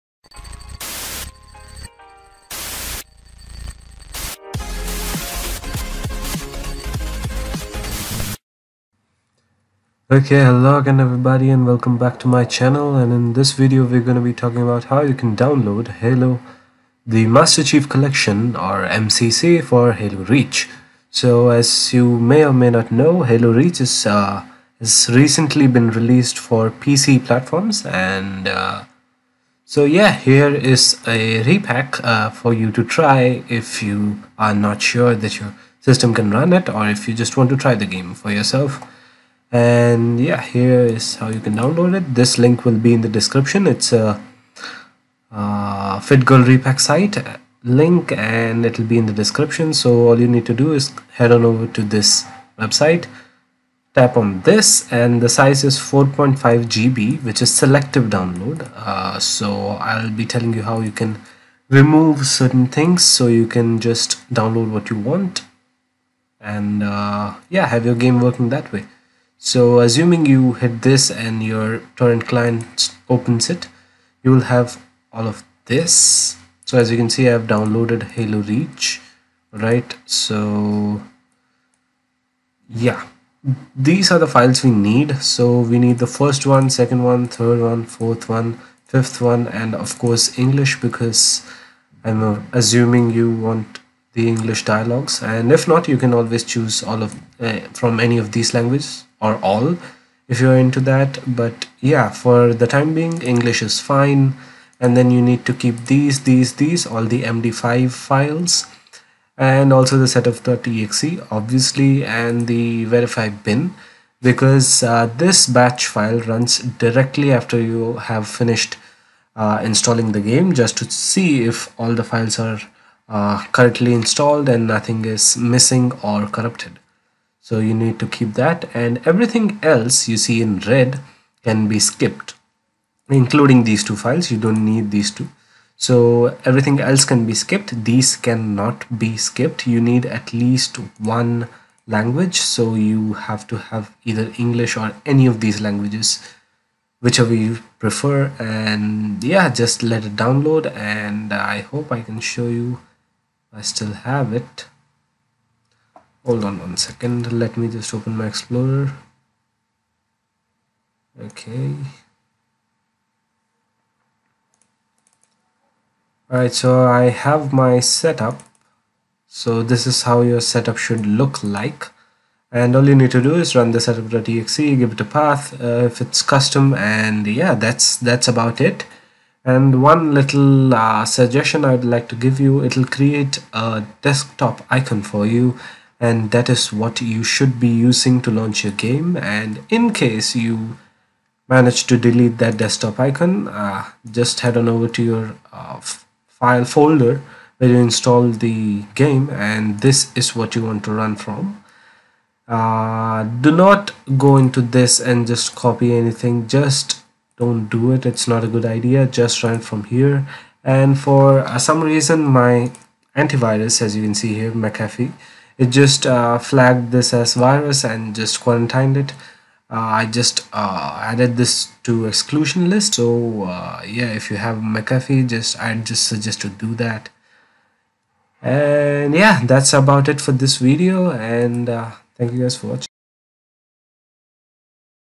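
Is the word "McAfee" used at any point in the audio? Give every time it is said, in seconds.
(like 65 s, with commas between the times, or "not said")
214 s, 224 s.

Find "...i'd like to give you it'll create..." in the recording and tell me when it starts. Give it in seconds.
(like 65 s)
181 s.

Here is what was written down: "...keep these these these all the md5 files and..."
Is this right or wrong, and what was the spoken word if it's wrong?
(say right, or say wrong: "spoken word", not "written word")
right.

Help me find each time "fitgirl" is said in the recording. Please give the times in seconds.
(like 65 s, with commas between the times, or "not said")
45 s.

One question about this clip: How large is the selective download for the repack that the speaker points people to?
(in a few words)
4.5 GB.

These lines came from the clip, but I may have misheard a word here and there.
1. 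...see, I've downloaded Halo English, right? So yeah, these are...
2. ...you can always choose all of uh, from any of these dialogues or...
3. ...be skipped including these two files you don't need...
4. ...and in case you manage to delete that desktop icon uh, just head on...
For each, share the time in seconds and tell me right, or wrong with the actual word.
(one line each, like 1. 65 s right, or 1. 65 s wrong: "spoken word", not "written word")
1. 77 s wrong: "Reach", not "English"
2. 95 s wrong: "languages", not "dialogues"
3. 131 s right
4. 189 s right.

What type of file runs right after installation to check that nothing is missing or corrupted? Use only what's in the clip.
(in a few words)
batch file.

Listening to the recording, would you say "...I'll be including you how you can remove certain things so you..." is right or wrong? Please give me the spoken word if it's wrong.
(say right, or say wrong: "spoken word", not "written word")
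wrong: "telling", not "including".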